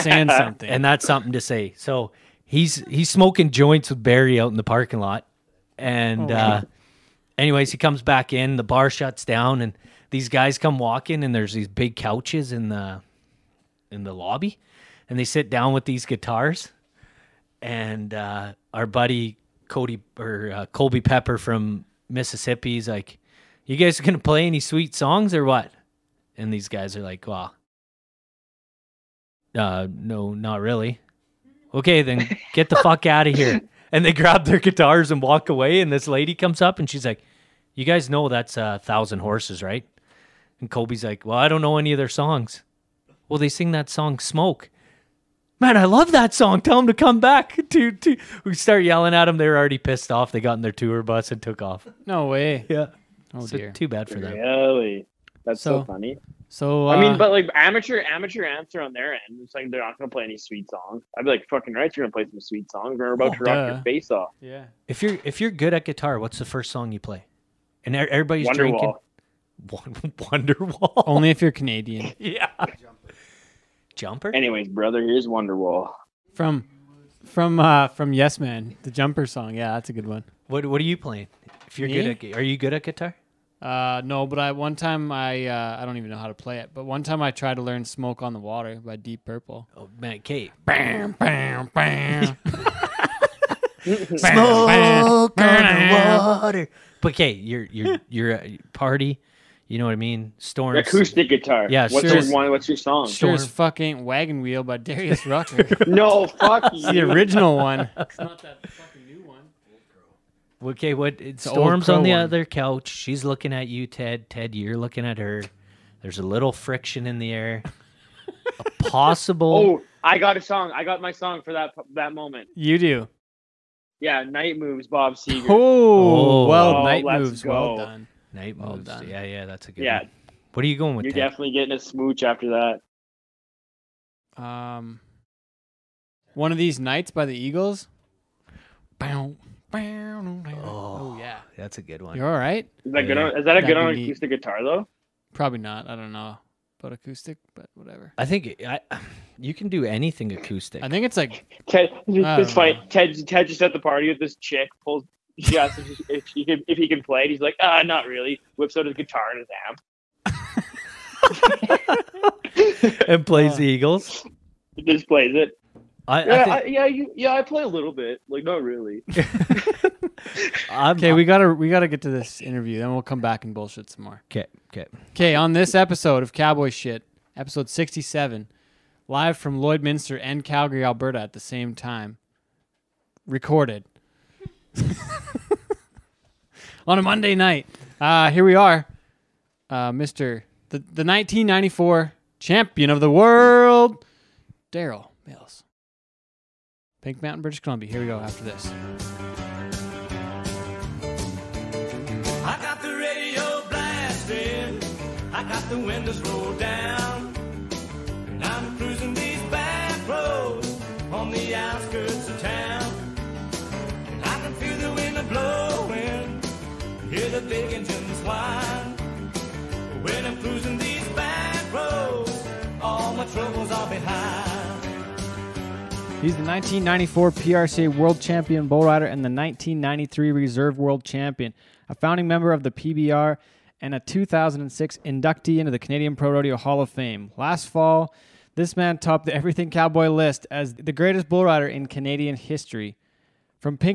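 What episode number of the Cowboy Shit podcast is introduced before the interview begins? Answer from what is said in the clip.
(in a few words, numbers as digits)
67.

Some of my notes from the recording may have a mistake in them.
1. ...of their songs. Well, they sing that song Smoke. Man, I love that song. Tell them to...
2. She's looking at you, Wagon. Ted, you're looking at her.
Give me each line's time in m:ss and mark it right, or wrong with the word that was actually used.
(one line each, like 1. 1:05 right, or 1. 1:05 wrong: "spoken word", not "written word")
1. 0:41 right
2. 1:52 wrong: "Ted", not "Wagon".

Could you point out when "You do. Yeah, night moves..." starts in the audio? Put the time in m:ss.
2:02.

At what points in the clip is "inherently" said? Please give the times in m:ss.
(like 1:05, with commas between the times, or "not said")
not said.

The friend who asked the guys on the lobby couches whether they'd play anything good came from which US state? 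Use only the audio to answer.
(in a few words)
Mississippi.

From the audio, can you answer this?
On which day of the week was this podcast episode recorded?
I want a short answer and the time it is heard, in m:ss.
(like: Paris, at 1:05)
Monday, at 3:07.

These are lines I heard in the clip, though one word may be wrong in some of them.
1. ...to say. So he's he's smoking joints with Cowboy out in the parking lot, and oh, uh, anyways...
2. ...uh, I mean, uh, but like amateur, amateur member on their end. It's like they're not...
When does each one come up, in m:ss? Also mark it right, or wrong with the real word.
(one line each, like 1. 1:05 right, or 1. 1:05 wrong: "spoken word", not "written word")
1. 0:01 wrong: "Barry", not "Cowboy"
2. 0:56 wrong: "answer", not "member".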